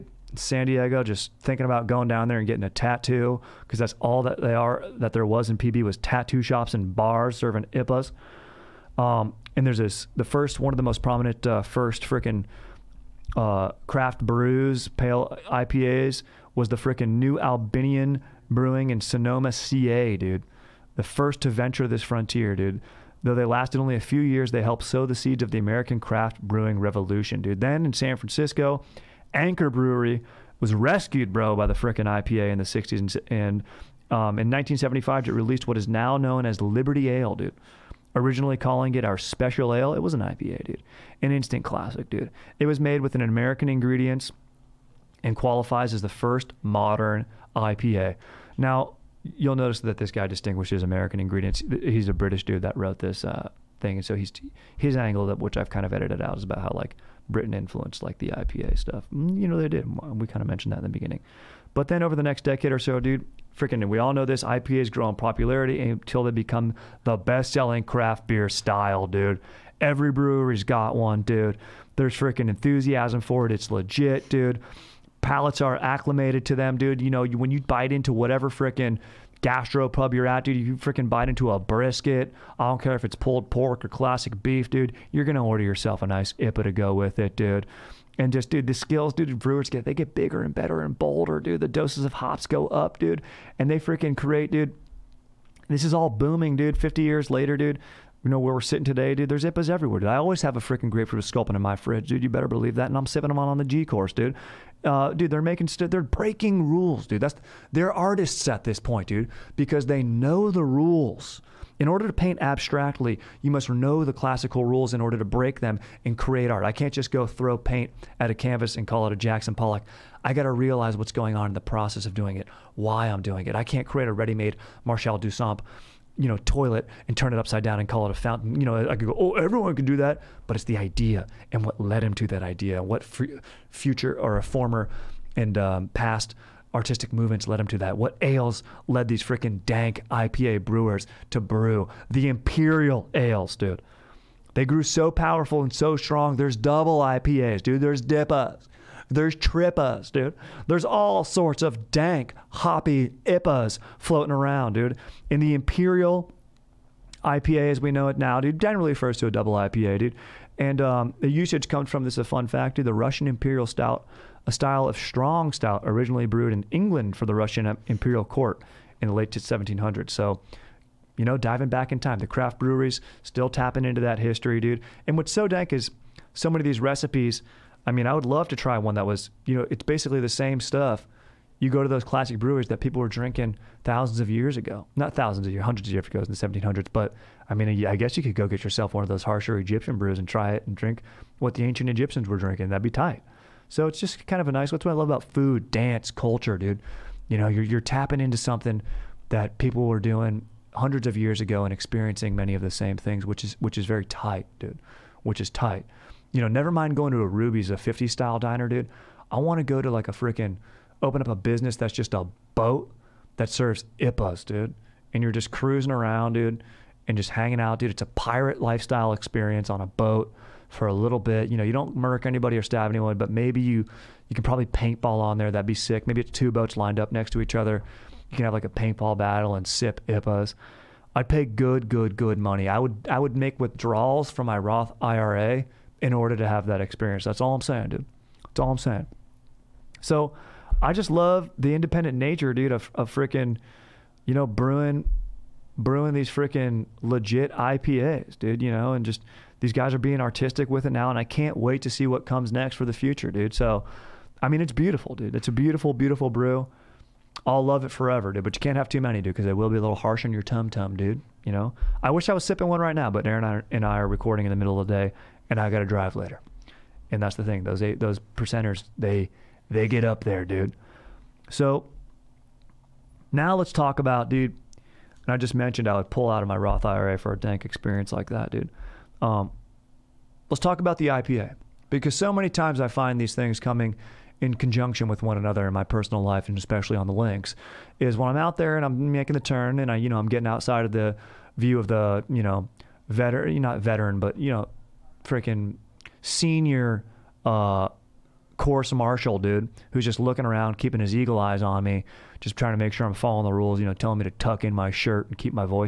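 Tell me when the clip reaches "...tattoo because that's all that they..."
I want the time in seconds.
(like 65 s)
2 s.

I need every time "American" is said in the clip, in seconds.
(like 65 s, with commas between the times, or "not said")
25 s, 43 s, 50 s.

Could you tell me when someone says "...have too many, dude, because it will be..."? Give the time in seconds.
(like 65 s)
258 s.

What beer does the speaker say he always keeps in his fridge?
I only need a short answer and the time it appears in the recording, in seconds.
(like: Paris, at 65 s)
Grapefruit Sculpin, at 100 s.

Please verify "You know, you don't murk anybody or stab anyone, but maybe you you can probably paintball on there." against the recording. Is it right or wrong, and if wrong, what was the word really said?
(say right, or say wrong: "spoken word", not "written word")
right.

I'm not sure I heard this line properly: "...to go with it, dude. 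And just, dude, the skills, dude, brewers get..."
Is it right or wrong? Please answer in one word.
right.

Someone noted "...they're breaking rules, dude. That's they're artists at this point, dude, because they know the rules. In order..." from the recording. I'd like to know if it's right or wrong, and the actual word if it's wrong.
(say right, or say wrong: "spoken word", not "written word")
right.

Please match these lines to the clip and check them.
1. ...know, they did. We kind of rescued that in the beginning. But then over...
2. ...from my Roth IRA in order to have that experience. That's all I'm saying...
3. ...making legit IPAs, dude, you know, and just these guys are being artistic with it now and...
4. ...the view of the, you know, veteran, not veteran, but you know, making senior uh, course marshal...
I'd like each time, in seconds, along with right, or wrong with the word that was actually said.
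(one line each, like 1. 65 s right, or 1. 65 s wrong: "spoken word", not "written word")
1. 59 s wrong: "mentioned", not "rescued"
2. 234 s right
3. 246 s wrong: "freaking", not "making"
4. 290 s wrong: "freaking", not "making".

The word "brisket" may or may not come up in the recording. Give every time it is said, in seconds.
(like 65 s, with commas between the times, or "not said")
81 s.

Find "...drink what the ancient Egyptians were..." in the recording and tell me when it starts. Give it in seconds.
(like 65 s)
190 s.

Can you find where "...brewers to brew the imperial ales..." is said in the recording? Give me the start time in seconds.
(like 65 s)
140 s.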